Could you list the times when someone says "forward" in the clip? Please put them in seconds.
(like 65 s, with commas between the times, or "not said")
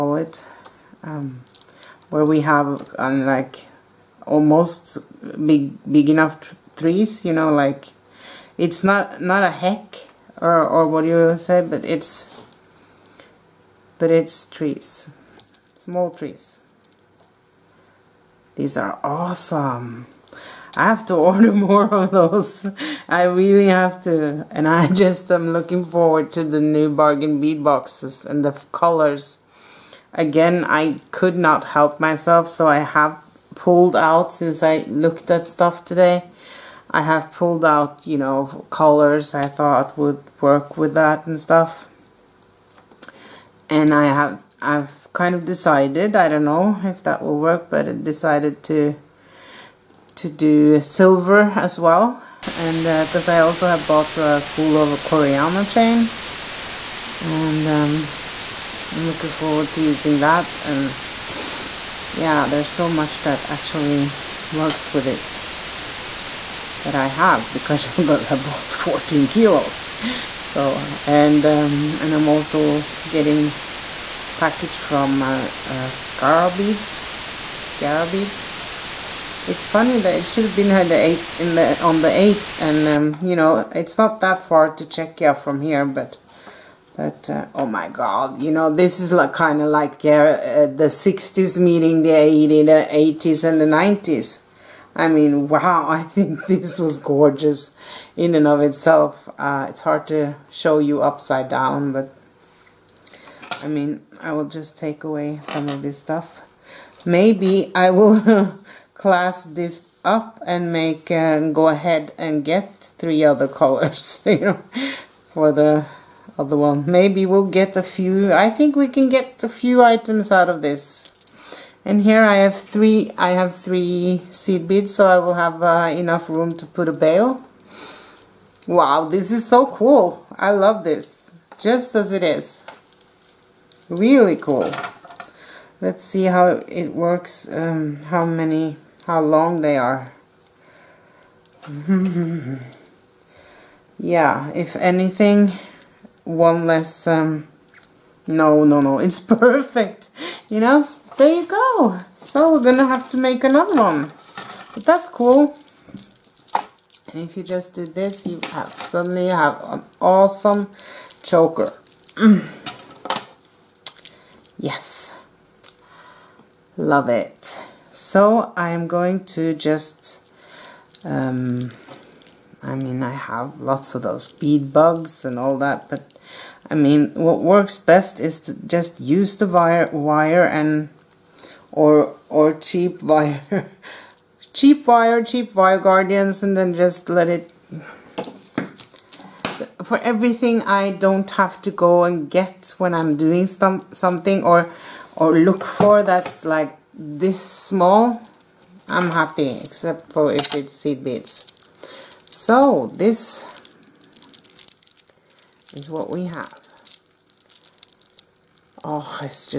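25 s, 59 s.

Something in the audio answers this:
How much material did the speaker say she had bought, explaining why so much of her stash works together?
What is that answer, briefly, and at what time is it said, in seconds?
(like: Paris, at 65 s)
14 kilos, at 68 s.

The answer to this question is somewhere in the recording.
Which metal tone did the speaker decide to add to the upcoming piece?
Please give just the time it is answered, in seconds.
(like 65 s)
50 s.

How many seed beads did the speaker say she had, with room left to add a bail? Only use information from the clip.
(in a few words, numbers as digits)
3.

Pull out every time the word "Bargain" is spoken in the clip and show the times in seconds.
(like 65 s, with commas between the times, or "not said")
26 s.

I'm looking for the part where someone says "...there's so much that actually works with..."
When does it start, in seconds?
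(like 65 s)
62 s.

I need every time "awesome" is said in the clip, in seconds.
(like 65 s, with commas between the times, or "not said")
19 s, 160 s.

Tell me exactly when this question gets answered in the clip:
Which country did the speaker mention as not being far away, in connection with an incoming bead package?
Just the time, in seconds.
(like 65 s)
85 s.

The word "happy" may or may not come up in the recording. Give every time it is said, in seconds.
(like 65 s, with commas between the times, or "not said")
199 s.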